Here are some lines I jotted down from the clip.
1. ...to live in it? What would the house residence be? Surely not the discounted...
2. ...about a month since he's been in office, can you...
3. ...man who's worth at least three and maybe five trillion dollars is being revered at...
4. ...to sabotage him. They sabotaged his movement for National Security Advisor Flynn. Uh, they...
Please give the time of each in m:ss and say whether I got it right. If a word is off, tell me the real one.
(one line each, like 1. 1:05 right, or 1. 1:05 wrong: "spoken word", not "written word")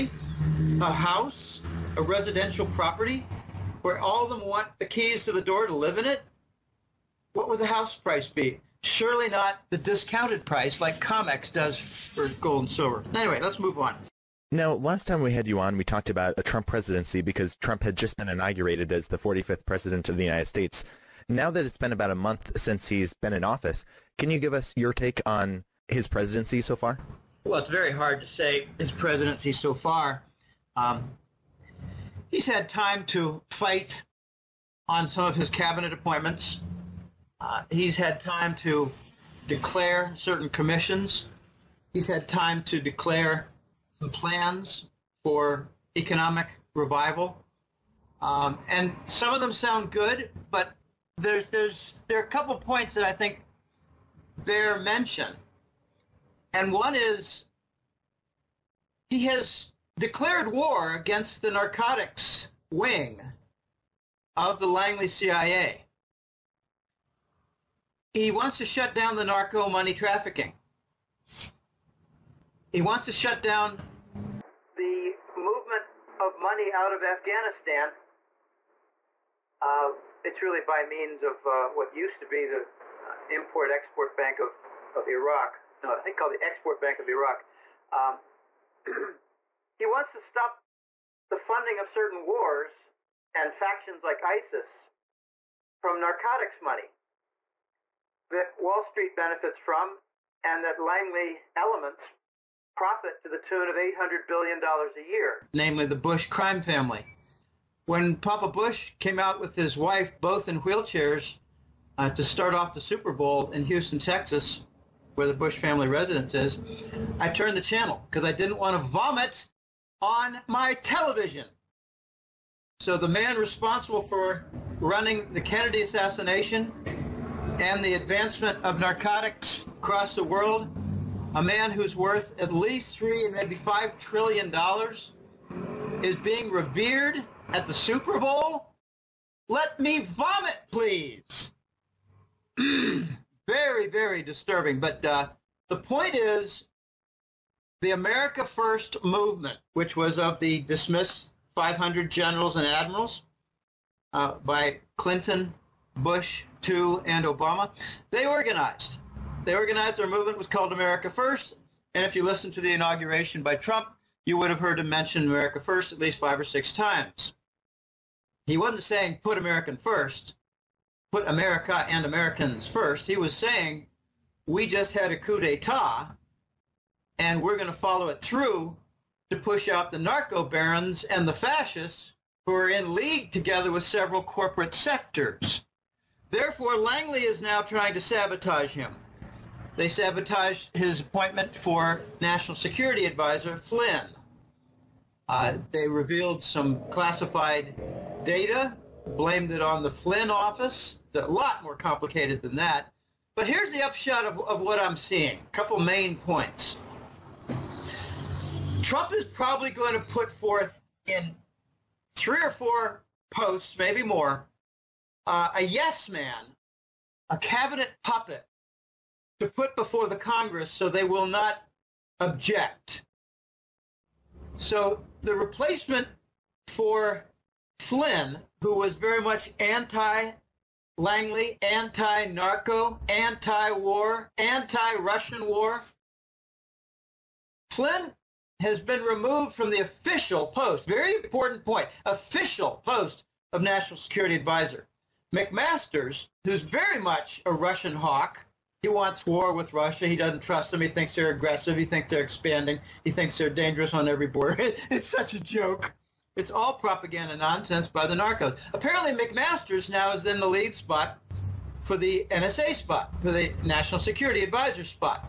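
1. 0:05 wrong: "price", not "residence"
2. 0:21 right
3. 2:11 right
4. 3:07 wrong: "appointment", not "movement".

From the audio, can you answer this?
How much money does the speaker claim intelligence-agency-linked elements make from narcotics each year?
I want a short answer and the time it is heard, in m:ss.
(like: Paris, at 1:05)
$800 billion, at 1:43.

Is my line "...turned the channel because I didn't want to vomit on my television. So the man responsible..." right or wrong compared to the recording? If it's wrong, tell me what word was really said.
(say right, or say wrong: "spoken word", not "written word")
right.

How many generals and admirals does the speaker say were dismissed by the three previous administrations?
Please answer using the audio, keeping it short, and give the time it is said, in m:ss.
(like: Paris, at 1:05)
500, at 2:31.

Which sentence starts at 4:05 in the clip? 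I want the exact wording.
McMaster's, who's very much a Russian hawk, he wants war with Russia.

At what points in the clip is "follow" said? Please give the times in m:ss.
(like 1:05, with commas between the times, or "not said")
2:57.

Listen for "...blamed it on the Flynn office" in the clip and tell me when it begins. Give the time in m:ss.
3:19.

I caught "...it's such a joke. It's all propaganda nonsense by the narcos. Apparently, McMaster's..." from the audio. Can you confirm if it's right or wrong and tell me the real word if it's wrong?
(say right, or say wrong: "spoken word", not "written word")
right.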